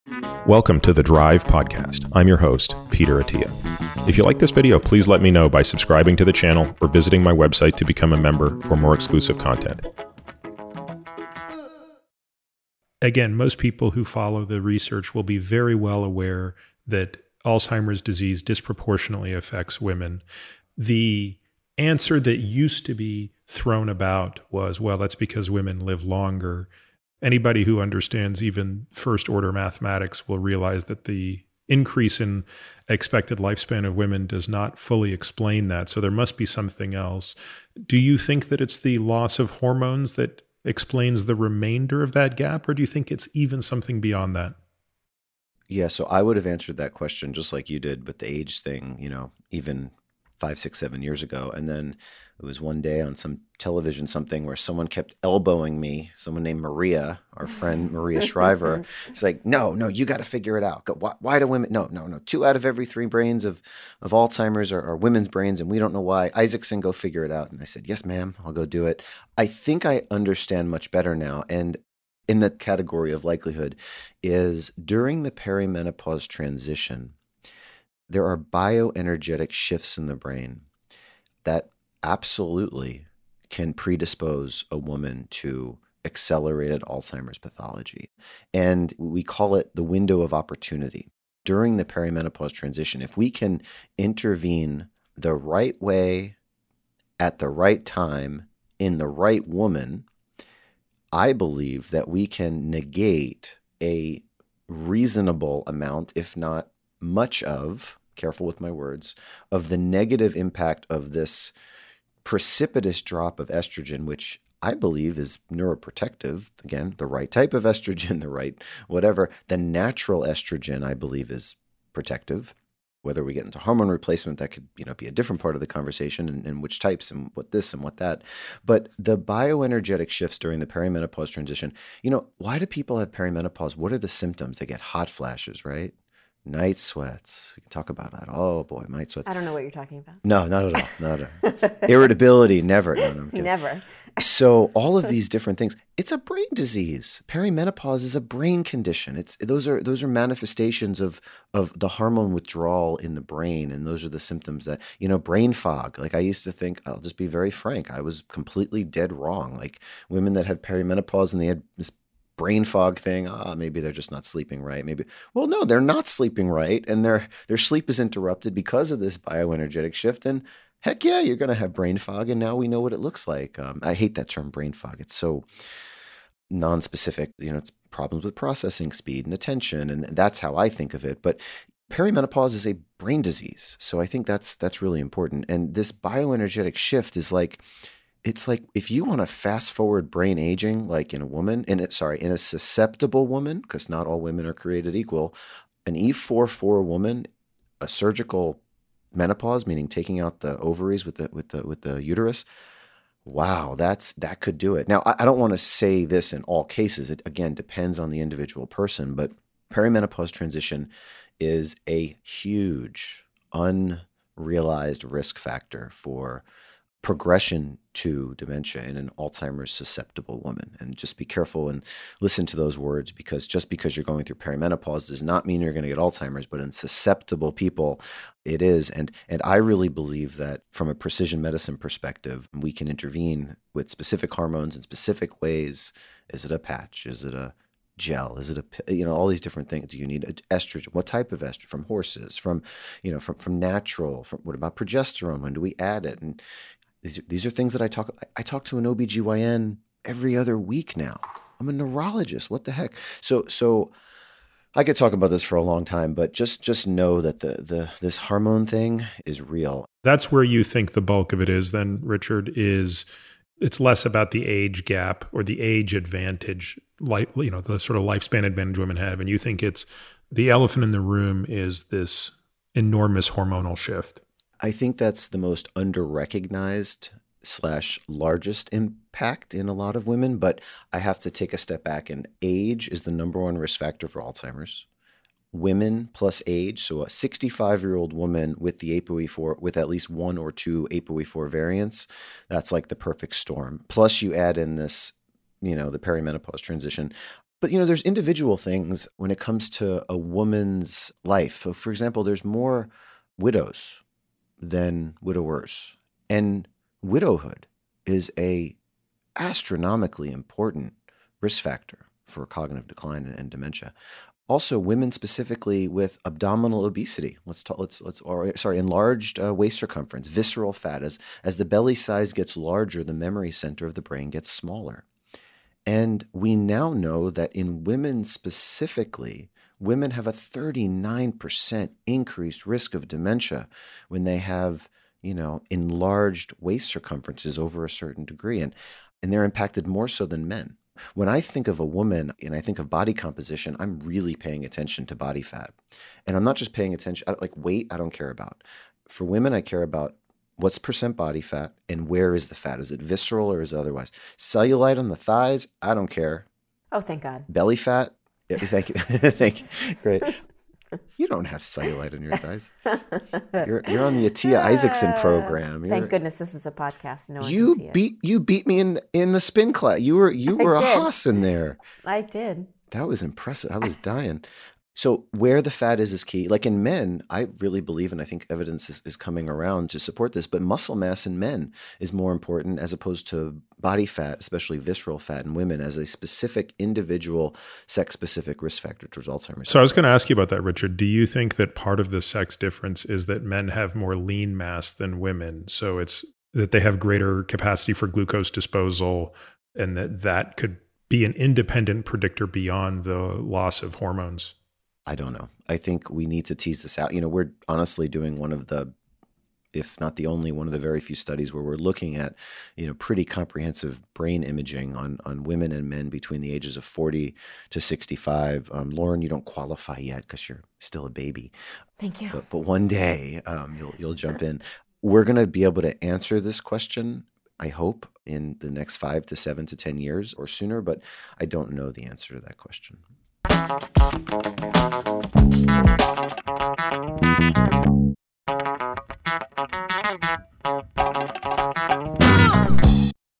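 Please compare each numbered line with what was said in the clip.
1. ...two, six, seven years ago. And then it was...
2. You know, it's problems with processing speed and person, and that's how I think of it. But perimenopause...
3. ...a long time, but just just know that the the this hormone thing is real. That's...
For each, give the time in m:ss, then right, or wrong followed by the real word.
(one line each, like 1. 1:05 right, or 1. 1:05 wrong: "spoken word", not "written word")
1. 0:50 wrong: "five", not "two"
2. 2:57 wrong: "attention", not "person"
3. 4:15 right.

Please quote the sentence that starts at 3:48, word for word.
And and I really believe that from a precision medicine perspective, we can intervene with specific hormones in specific ways.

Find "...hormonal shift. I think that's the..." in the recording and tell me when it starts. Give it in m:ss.
4:33.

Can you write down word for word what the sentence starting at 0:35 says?
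So there must be something else.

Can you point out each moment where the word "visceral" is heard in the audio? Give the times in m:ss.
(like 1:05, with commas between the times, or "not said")
5:20, 5:53, 6:24.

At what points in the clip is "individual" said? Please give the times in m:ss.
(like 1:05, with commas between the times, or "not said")
3:28, 4:58, 6:26.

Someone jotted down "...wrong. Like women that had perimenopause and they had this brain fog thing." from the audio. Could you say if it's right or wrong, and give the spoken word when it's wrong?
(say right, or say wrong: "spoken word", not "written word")
right.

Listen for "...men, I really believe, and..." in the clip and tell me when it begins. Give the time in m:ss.
6:16.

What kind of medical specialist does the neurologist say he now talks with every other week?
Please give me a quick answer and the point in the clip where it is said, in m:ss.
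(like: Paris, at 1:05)
OBGYN, at 4:08.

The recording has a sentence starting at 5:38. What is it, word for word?
And, and they're impacted more so than men.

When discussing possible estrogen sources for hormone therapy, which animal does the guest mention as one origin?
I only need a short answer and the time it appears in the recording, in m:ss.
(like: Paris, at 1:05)
horses, at 4:01.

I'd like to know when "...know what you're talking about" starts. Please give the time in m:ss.
2:19.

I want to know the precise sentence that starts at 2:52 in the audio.
And now we know what it looks like.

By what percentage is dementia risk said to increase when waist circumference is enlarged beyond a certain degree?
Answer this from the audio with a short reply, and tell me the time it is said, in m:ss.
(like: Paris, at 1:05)
39%, at 5:30.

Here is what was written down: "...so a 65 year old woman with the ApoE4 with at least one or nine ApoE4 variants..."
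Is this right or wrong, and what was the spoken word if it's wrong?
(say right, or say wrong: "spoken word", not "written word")
wrong: "two", not "nine".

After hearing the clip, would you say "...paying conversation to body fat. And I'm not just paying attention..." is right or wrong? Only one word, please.
wrong.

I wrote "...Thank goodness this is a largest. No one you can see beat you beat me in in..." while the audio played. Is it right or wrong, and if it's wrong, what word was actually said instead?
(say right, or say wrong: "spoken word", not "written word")
wrong: "podcast", not "largest".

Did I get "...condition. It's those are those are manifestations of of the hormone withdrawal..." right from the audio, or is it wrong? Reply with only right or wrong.
right.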